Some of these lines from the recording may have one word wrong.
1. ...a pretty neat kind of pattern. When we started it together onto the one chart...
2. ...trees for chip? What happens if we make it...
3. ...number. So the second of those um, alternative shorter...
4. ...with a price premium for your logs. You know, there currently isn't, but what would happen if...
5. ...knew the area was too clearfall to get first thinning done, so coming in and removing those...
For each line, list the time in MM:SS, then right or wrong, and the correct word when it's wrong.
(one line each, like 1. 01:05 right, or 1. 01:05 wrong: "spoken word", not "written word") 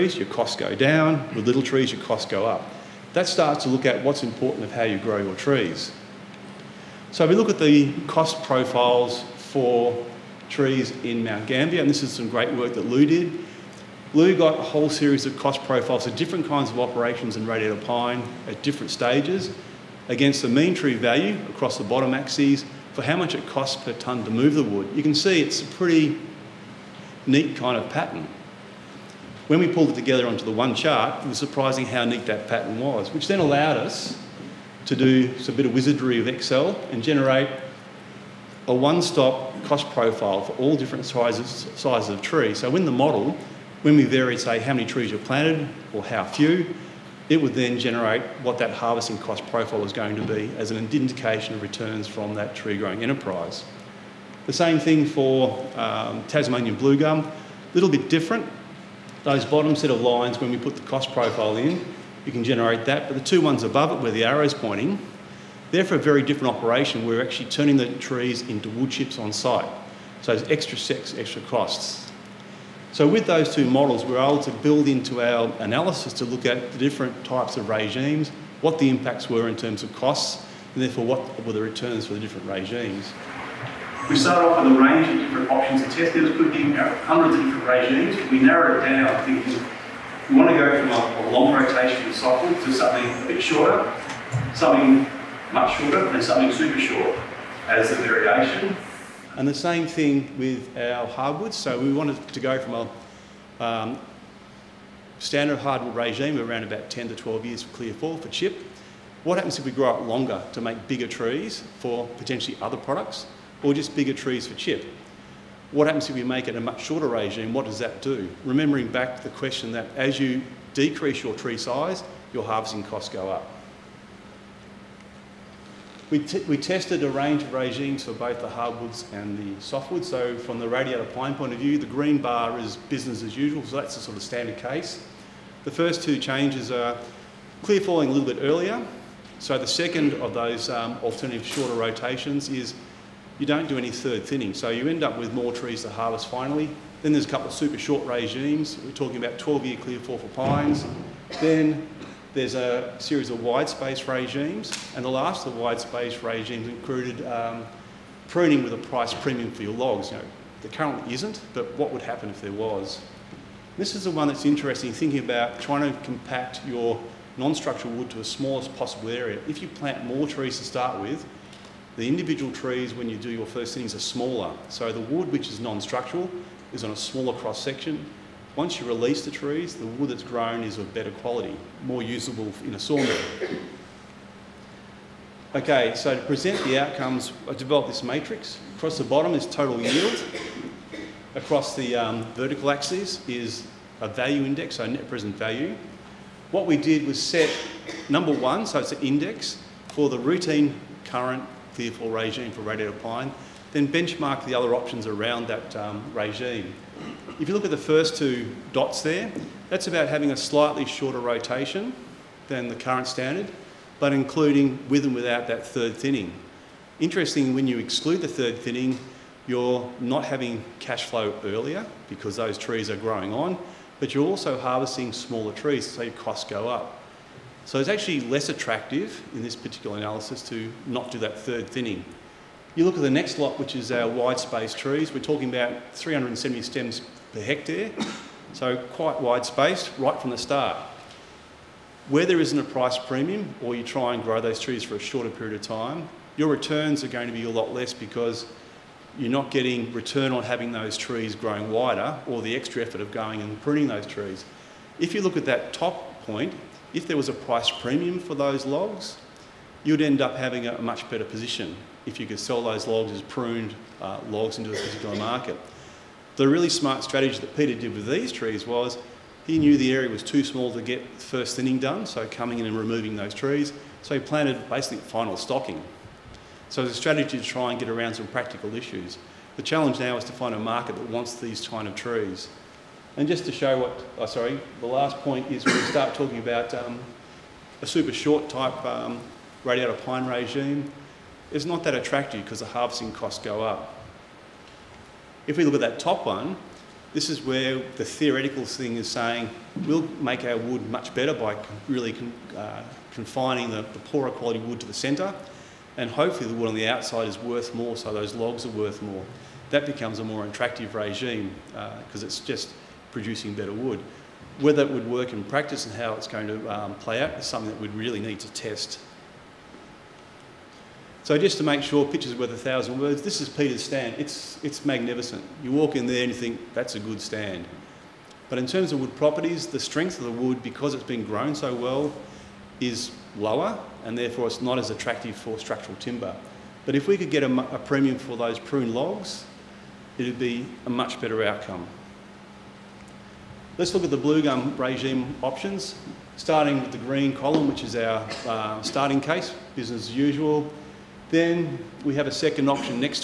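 1. 00:25 wrong: "pulled", not "started"
2. 01:54 right
3. 02:18 wrong: "earlier", not "number"
4. 02:38 right
5. 04:29 wrong: "small", not "clearfall".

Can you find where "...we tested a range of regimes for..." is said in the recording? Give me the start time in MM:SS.
02:06.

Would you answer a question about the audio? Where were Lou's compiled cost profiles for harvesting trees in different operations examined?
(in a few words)
Mount Gambier.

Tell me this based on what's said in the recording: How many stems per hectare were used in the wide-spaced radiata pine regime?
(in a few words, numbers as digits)
370.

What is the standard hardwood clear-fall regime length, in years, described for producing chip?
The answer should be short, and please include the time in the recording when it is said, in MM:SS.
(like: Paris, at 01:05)
10 to 12 years, at 01:46.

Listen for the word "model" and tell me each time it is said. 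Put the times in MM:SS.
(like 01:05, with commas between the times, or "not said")
00:42, 01:13.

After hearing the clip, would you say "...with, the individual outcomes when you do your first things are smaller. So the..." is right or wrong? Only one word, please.
wrong.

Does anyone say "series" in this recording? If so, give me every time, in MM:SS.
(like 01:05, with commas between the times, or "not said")
00:14, 02:32.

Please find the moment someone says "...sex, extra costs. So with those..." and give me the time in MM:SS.
01:10.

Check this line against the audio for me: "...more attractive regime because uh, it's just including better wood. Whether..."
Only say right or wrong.
wrong.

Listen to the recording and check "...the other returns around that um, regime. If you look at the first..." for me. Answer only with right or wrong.
wrong.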